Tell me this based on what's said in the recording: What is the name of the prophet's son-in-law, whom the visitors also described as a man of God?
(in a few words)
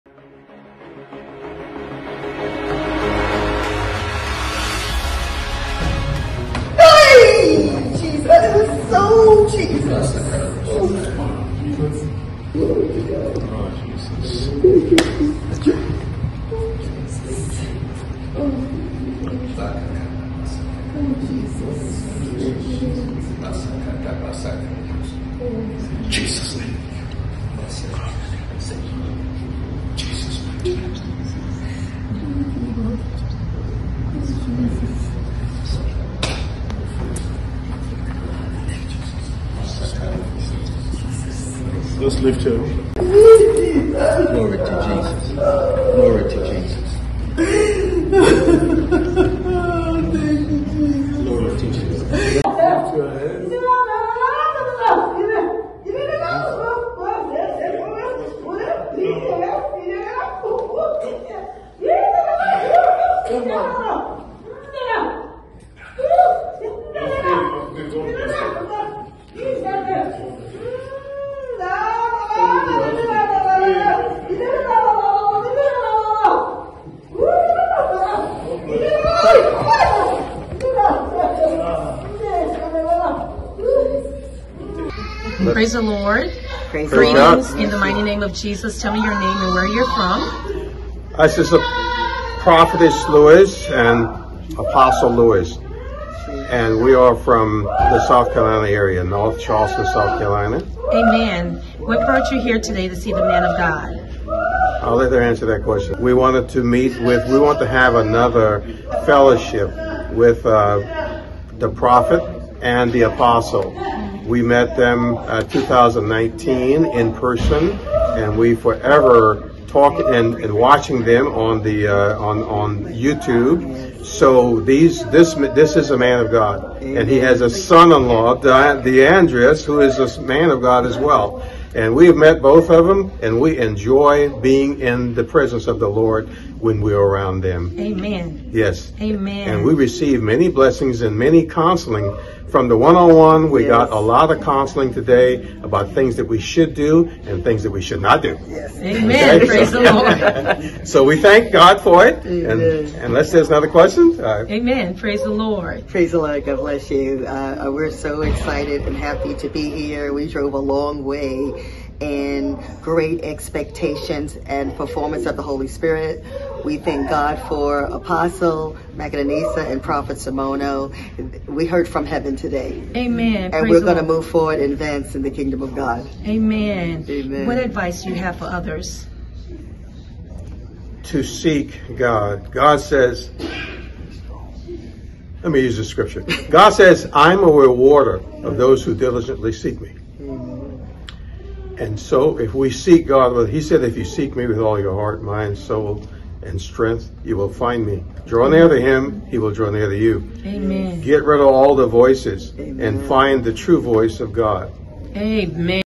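DeAndreas.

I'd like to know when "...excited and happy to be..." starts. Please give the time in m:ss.
2:38.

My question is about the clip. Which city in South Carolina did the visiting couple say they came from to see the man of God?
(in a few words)
North Charleston.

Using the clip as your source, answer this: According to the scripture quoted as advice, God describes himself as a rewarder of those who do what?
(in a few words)
Diligently seek me.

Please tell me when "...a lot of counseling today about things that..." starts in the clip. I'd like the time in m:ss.
2:23.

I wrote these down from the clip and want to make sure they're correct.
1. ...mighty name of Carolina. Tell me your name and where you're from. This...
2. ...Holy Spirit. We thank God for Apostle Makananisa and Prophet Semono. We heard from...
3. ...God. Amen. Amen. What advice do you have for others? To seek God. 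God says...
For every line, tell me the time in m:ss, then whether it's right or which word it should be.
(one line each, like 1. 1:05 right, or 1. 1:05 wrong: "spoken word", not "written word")
1. 1:27 wrong: "Jesus", not "Carolina"
2. 2:45 right
3. 2:55 right.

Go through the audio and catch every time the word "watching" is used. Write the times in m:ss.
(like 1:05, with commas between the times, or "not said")
2:00.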